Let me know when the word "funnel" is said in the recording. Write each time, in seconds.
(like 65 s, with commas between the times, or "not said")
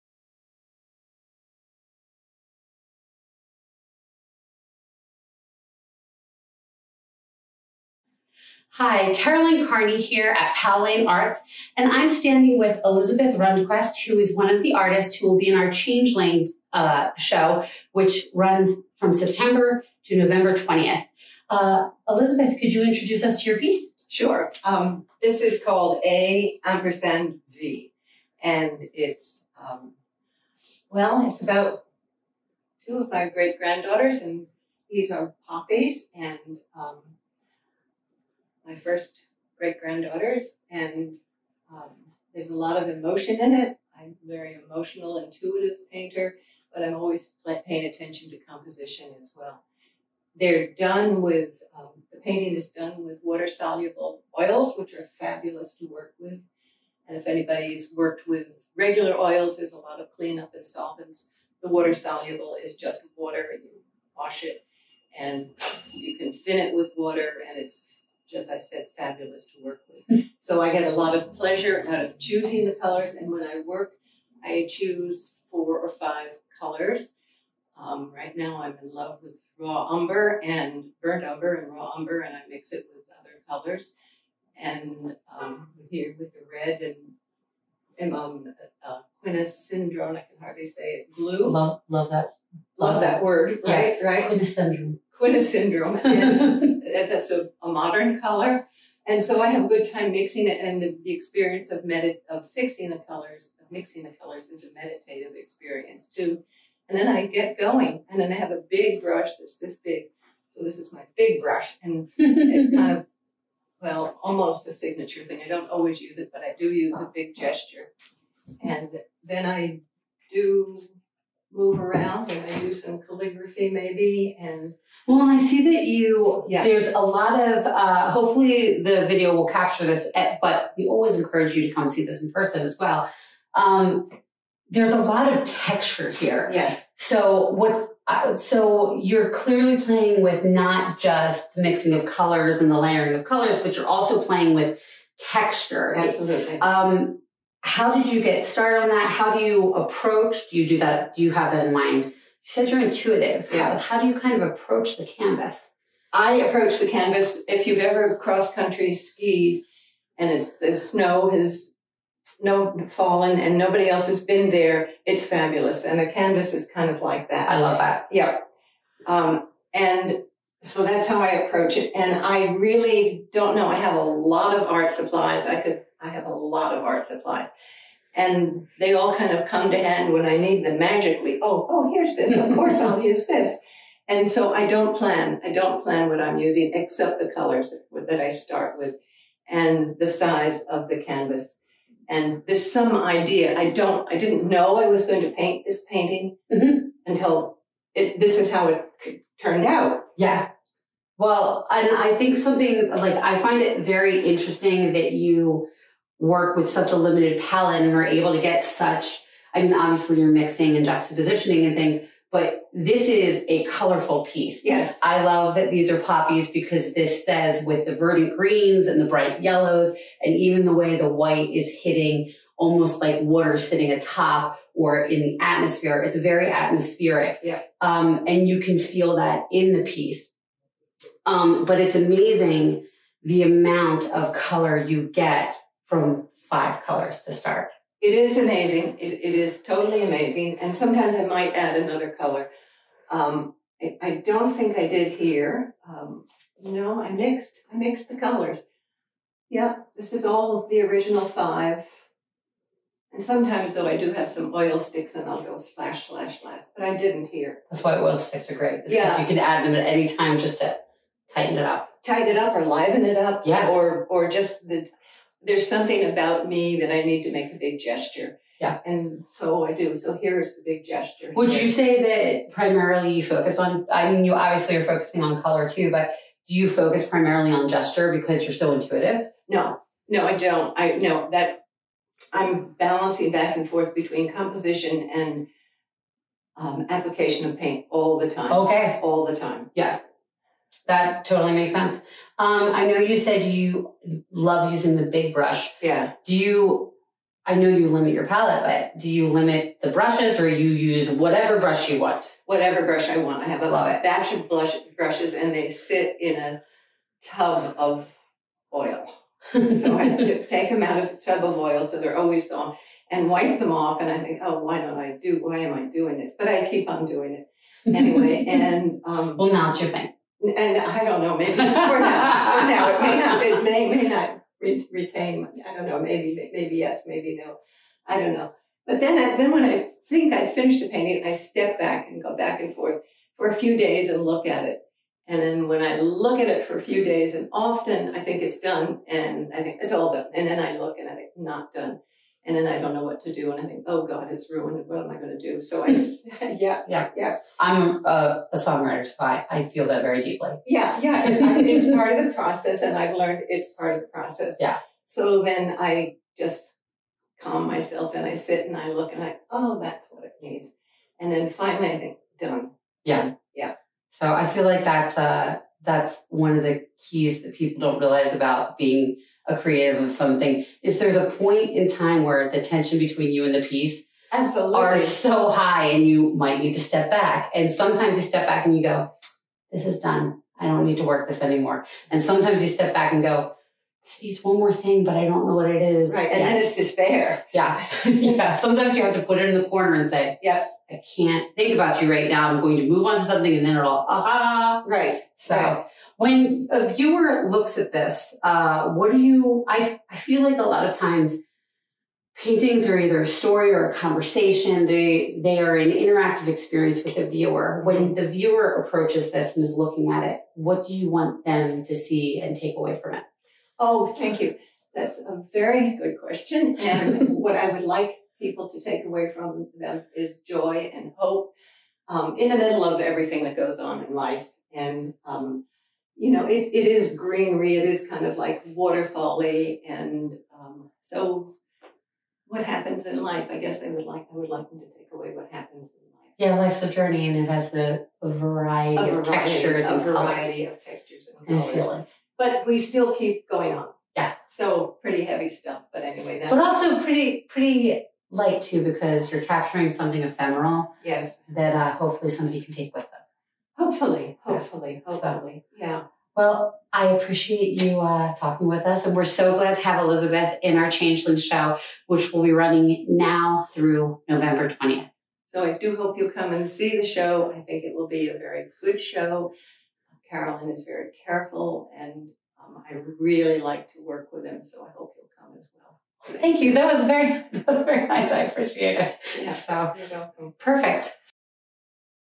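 not said.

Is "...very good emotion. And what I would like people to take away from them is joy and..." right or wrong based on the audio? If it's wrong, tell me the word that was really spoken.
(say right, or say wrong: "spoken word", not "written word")
wrong: "question", not "emotion".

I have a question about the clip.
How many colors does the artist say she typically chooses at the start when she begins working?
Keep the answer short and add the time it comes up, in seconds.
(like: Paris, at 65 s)
4 or 5, at 75 s.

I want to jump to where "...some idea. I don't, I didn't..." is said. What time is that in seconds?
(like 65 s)
192 s.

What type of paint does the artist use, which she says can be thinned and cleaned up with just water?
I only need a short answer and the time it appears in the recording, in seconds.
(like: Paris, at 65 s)
Water soluble oils, at 53 s.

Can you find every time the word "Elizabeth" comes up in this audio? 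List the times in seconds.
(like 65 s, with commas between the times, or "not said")
12 s, 22 s, 460 s.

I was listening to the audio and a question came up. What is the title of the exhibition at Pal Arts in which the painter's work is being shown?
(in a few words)
Changelings.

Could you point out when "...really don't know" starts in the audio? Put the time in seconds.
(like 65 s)
172 s.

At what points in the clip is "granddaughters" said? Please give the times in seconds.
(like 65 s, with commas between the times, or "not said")
33 s, 39 s.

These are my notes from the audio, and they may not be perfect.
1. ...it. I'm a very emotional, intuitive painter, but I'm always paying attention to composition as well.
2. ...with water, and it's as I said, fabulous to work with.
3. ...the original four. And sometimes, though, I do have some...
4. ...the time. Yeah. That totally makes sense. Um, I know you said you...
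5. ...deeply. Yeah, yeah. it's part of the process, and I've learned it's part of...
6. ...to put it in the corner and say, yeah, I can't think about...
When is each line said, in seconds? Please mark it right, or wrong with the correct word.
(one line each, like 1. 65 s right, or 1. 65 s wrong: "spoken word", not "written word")
1. 43 s right
2. 66 s right
3. 250 s wrong: "five", not "four"
4. 289 s right
5. 350 s right
6. 389 s right.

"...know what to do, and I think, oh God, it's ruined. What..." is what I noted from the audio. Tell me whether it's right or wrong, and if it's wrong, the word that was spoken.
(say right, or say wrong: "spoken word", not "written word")
right.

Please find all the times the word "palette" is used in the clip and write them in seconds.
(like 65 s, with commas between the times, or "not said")
207 s, 298 s.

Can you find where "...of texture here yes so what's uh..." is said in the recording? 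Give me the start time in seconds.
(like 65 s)
135 s.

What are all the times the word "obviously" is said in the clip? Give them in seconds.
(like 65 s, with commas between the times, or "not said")
209 s, 274 s.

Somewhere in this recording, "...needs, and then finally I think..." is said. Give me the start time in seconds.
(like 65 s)
360 s.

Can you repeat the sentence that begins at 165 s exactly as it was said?
And the canvas is kind of like that.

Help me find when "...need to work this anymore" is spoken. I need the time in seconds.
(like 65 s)
380 s.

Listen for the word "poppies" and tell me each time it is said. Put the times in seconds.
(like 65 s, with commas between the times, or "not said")
35 s, 215 s.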